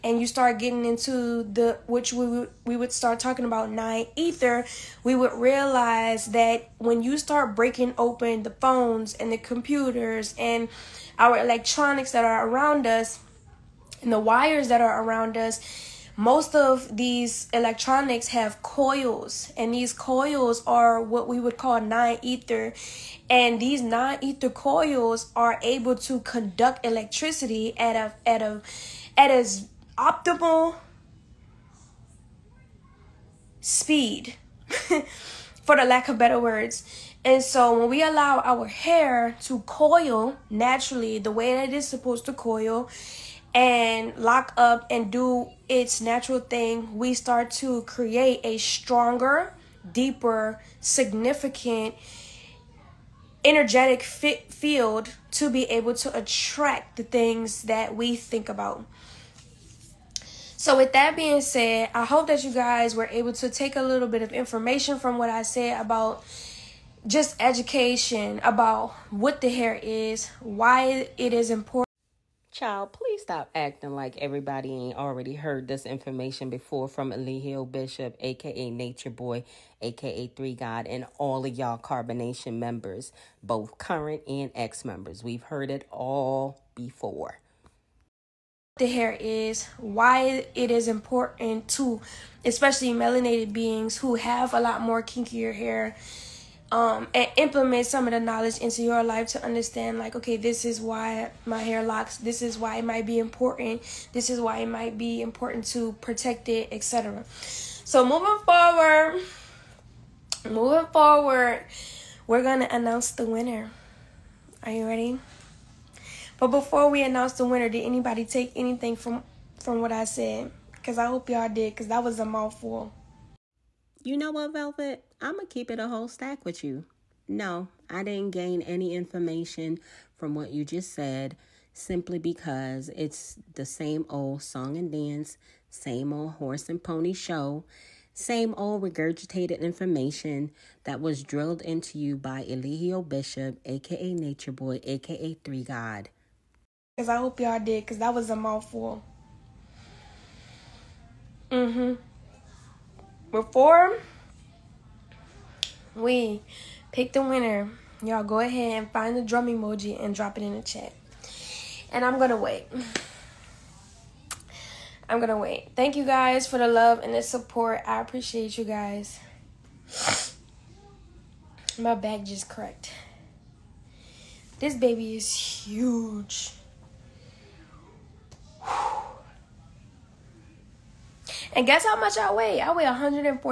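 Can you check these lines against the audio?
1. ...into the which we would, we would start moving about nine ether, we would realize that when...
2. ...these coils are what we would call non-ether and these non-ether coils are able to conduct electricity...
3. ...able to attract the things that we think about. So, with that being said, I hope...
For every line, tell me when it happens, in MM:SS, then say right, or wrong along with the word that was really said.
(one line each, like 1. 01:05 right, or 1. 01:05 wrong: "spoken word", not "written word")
1. 00:00 wrong: "talking", not "moving"
2. 00:19 right
3. 00:55 right.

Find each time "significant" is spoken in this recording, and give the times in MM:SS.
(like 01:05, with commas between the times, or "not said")
00:50.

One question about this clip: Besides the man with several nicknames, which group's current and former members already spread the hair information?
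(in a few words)
Carbonnation.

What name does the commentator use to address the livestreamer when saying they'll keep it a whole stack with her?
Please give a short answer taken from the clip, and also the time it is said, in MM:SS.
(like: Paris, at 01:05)
Velvet, at 02:04.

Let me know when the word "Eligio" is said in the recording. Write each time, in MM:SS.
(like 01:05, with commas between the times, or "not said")
01:17, 02:22.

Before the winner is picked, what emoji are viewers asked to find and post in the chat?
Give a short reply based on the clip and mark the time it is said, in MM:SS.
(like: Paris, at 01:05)
Drum emoji, at 02:39.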